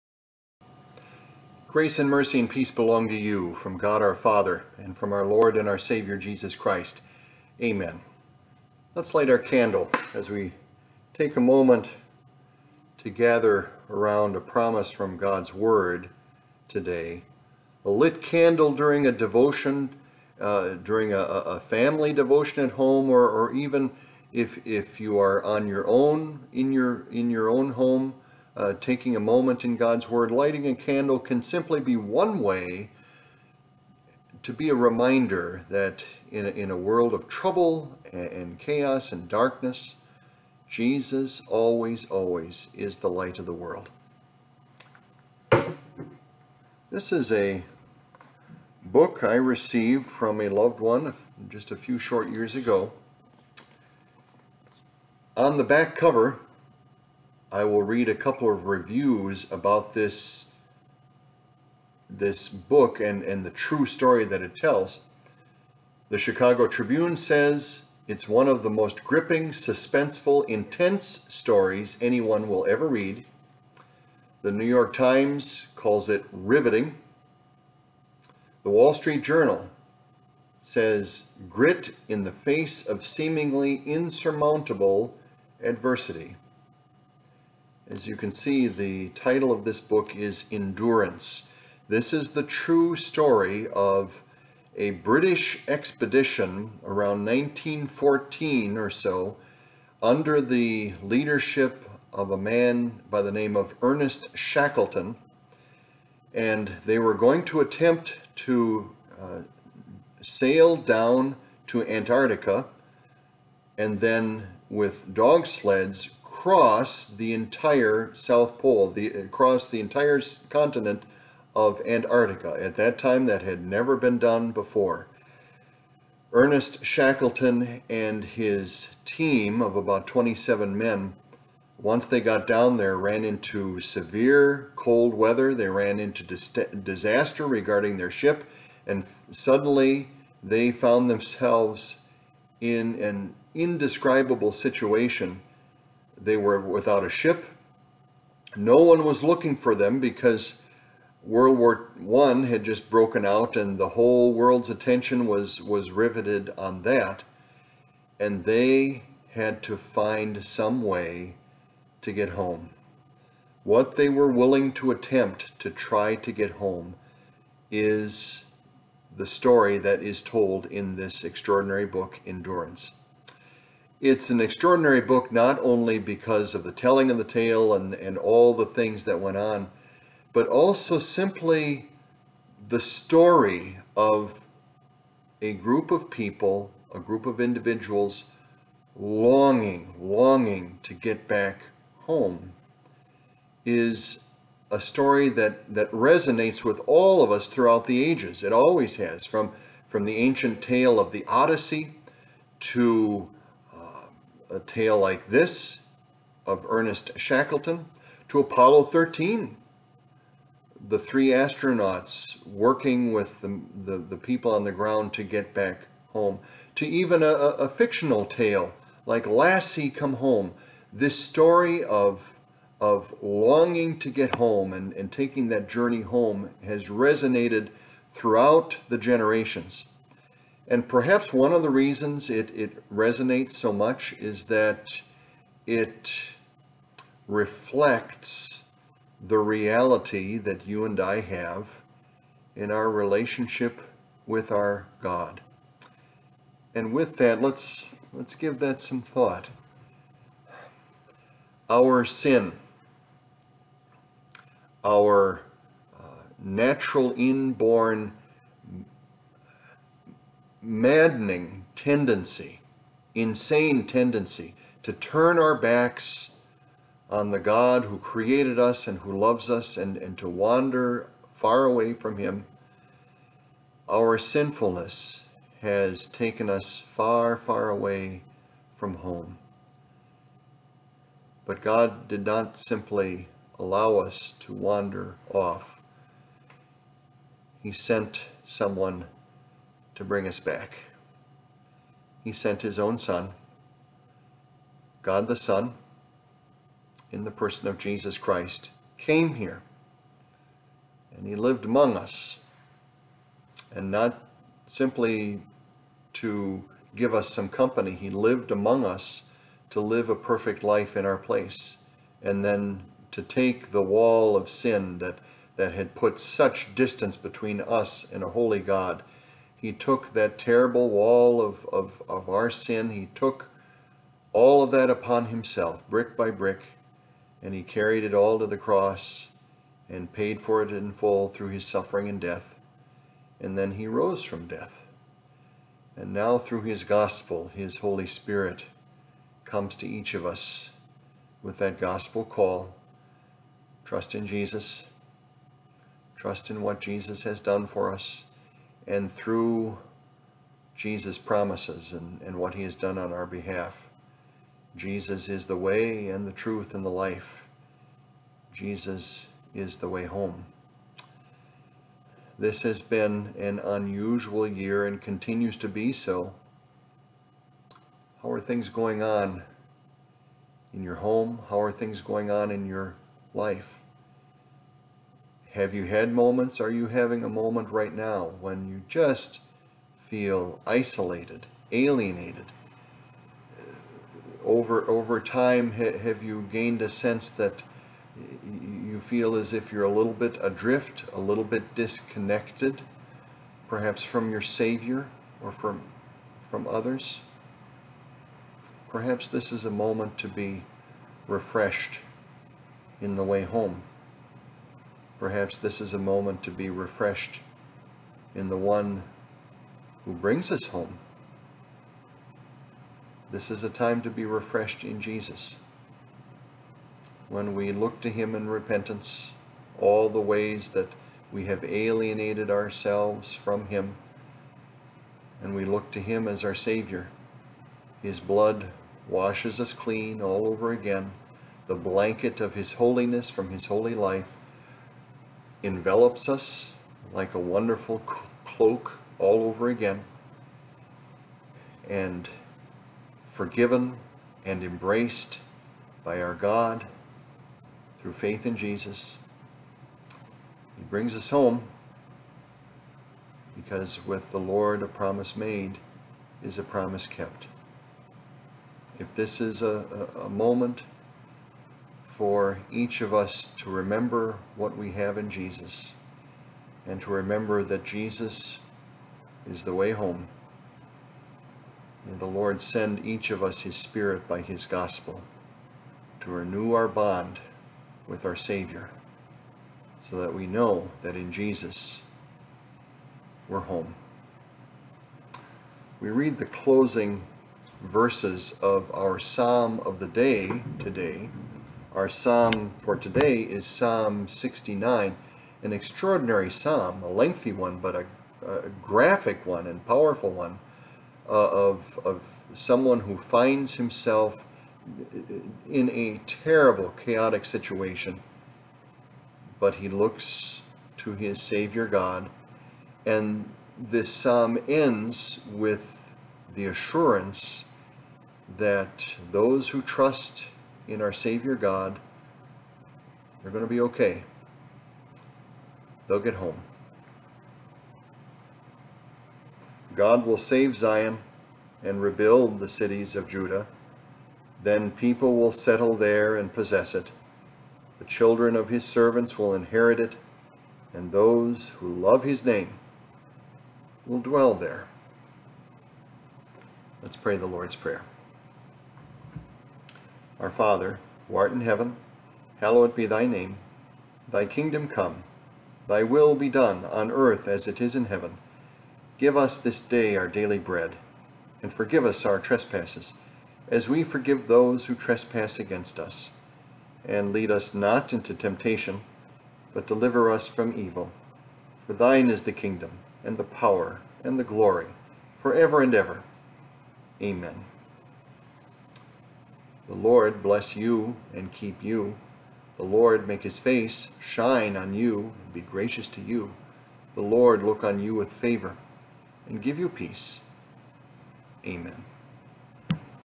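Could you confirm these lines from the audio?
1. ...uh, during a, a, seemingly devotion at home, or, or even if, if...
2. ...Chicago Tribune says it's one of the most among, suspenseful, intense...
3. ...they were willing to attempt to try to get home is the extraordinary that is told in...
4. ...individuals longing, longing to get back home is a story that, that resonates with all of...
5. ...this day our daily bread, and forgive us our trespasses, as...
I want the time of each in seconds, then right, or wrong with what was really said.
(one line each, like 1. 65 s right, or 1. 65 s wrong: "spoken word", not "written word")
1. 20 s wrong: "family", not "seemingly"
2. 66 s wrong: "gripping", not "among"
3. 163 s wrong: "story", not "extraordinary"
4. 187 s right
5. 559 s right.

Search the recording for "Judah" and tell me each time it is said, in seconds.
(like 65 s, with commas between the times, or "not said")
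533 s.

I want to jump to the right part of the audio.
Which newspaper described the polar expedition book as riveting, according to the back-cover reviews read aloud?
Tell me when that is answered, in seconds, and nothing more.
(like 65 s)
74 s.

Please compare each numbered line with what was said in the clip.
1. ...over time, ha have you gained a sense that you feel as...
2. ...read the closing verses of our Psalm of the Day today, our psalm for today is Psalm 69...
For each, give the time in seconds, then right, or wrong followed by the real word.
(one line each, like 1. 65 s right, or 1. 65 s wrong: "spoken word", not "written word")
1. 384 s right
2. 486 s right.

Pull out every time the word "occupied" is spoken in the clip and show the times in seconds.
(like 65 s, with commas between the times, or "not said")
not said.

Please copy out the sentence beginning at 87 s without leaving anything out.
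As you can see, the title of this book is Endurance.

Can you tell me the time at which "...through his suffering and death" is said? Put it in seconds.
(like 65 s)
331 s.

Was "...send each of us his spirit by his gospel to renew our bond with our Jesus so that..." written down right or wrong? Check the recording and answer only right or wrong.
wrong.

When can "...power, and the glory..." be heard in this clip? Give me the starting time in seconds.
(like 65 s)
573 s.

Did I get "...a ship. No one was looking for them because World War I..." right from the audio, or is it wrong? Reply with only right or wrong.
right.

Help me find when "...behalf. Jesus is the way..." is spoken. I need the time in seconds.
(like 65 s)
353 s.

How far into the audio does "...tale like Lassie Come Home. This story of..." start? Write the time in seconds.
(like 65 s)
218 s.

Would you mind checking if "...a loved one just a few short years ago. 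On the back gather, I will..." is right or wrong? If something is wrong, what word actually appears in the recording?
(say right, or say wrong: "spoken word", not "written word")
wrong: "cover", not "gather".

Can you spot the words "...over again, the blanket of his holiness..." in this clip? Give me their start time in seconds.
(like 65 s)
430 s.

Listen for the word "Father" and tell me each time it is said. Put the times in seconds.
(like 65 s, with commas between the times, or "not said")
4 s, 550 s.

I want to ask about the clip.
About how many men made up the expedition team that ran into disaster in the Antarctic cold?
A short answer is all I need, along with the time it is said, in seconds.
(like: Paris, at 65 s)
27, at 130 s.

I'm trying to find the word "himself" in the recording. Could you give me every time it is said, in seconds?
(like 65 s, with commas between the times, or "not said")
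325 s, 503 s.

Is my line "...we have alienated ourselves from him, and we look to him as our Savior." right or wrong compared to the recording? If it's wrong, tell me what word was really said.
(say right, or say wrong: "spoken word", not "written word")
right.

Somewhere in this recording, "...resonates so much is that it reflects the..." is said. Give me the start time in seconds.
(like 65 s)
232 s.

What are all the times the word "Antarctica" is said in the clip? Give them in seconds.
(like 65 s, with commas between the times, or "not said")
111 s, 121 s.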